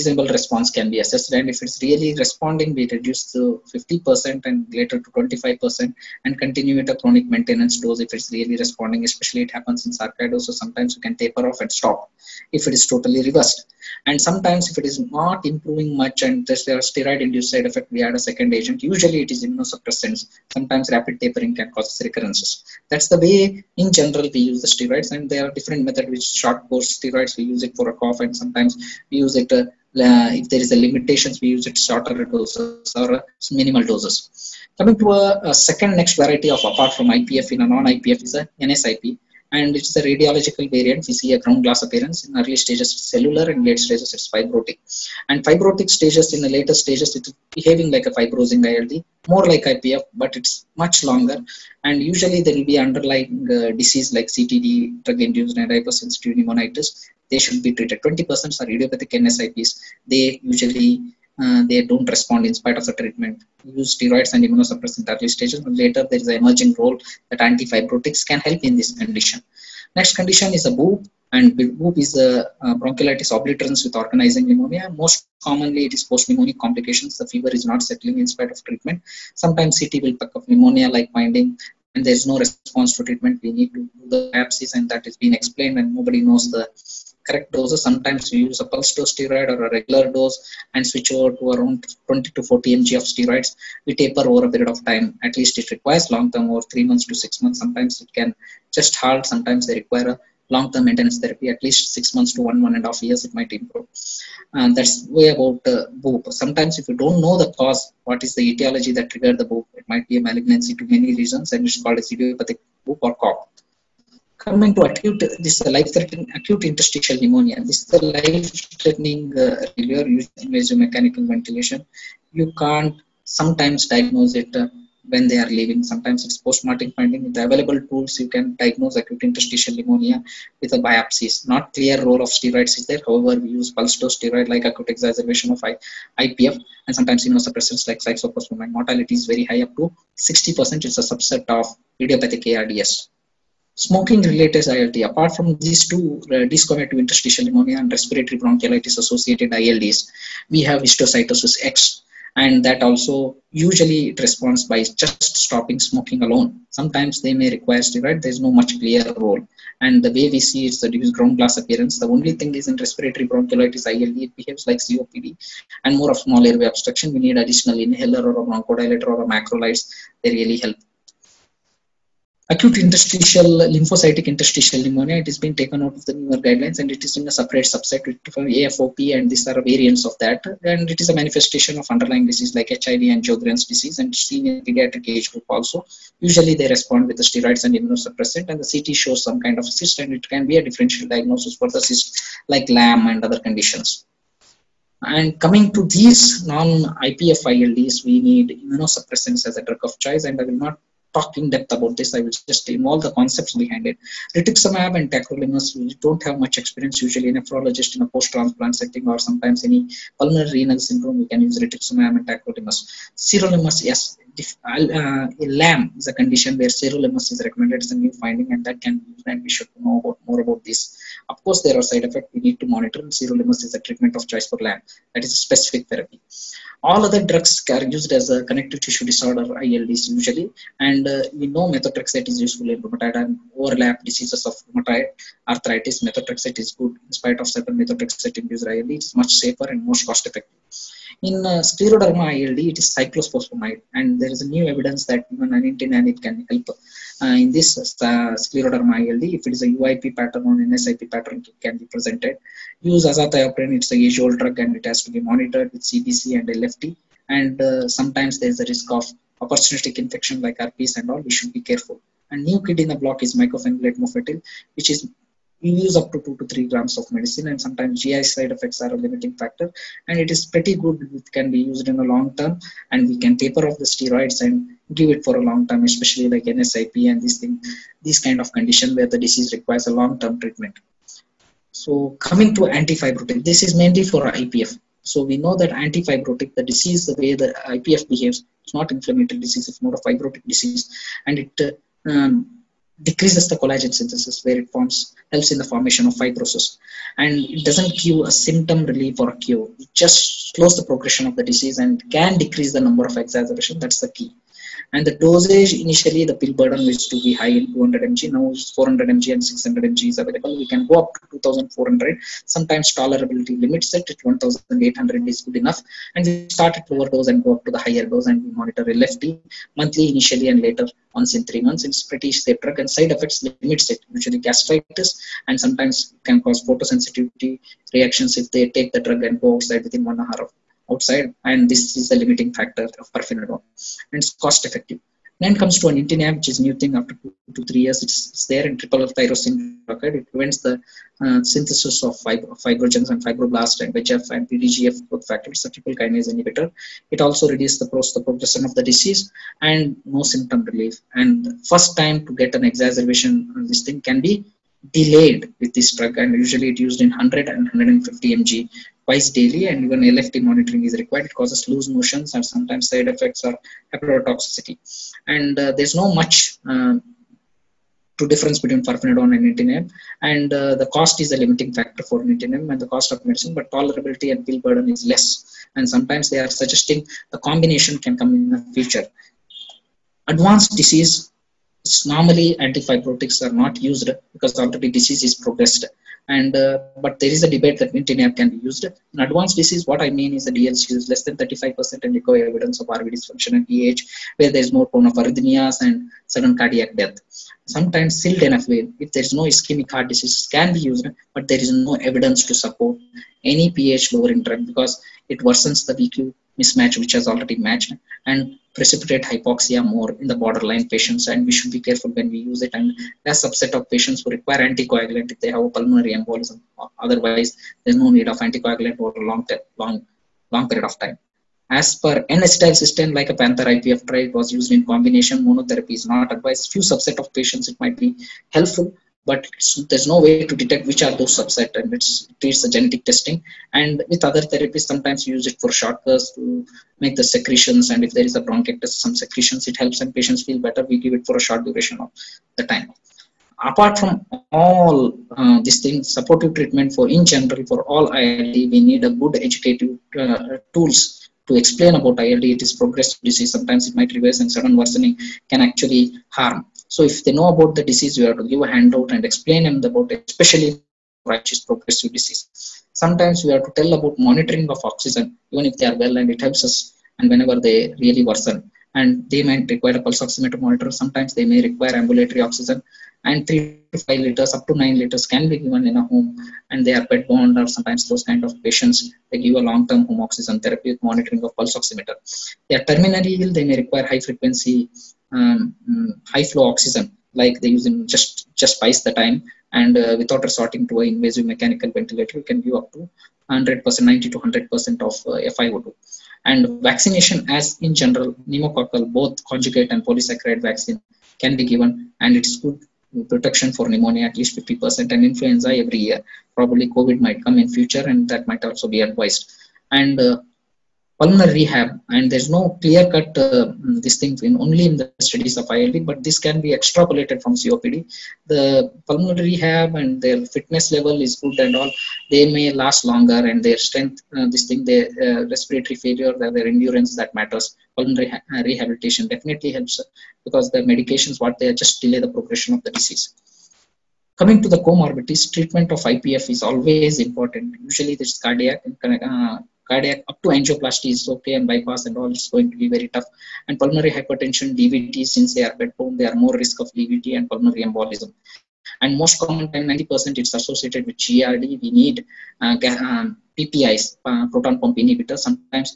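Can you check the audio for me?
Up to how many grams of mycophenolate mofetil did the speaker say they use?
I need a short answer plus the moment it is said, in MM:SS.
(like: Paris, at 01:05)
2 to 3 grams, at 04:26.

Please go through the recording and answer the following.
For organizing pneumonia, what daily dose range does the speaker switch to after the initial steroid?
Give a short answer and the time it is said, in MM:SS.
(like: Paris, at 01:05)
20 to 40 mg, at 01:32.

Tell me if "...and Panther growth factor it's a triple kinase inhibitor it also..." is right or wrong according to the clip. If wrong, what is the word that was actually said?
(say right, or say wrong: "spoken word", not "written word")
wrong: "PDGF", not "Panther".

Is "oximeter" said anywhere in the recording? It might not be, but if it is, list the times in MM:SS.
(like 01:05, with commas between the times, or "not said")
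07:50, 08:01.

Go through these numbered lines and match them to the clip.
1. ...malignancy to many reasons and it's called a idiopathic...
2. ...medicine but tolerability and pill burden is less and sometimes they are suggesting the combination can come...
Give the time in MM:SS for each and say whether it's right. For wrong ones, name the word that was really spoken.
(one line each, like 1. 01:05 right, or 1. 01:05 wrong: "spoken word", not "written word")
1. 01:50 right
2. 06:13 right.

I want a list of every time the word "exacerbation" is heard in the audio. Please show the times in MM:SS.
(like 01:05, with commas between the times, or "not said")
02:14, 05:03, 05:52.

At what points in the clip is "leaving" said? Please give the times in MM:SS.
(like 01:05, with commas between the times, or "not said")
02:05.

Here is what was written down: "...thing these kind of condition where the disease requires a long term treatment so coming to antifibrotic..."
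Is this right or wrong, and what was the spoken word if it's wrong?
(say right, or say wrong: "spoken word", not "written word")
right.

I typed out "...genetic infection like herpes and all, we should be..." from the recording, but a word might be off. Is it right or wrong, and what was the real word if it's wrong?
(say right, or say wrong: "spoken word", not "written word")
wrong: "opportunistic", not "genetic".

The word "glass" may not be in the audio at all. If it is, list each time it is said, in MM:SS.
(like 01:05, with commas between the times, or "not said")
00:41, 02:41.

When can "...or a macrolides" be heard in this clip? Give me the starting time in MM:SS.
02:49.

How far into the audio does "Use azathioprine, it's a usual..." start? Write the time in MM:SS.
04:12.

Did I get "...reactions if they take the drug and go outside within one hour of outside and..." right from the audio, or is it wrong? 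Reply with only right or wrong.
right.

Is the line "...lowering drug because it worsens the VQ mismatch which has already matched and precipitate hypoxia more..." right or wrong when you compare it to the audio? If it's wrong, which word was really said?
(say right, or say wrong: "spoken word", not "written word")
right.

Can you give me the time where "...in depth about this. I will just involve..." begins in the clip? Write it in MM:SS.
03:21.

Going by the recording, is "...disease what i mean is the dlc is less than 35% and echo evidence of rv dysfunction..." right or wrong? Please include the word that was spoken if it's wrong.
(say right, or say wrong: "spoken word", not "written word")
right.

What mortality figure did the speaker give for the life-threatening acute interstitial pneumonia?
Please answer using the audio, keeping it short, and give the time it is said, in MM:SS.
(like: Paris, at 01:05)
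up to 60%, at 02:19.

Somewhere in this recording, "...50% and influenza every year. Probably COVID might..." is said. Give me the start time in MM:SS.
08:24.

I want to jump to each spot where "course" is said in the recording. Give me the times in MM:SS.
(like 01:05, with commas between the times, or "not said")
00:26, 03:41.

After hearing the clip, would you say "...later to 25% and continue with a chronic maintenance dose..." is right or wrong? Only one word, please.
right.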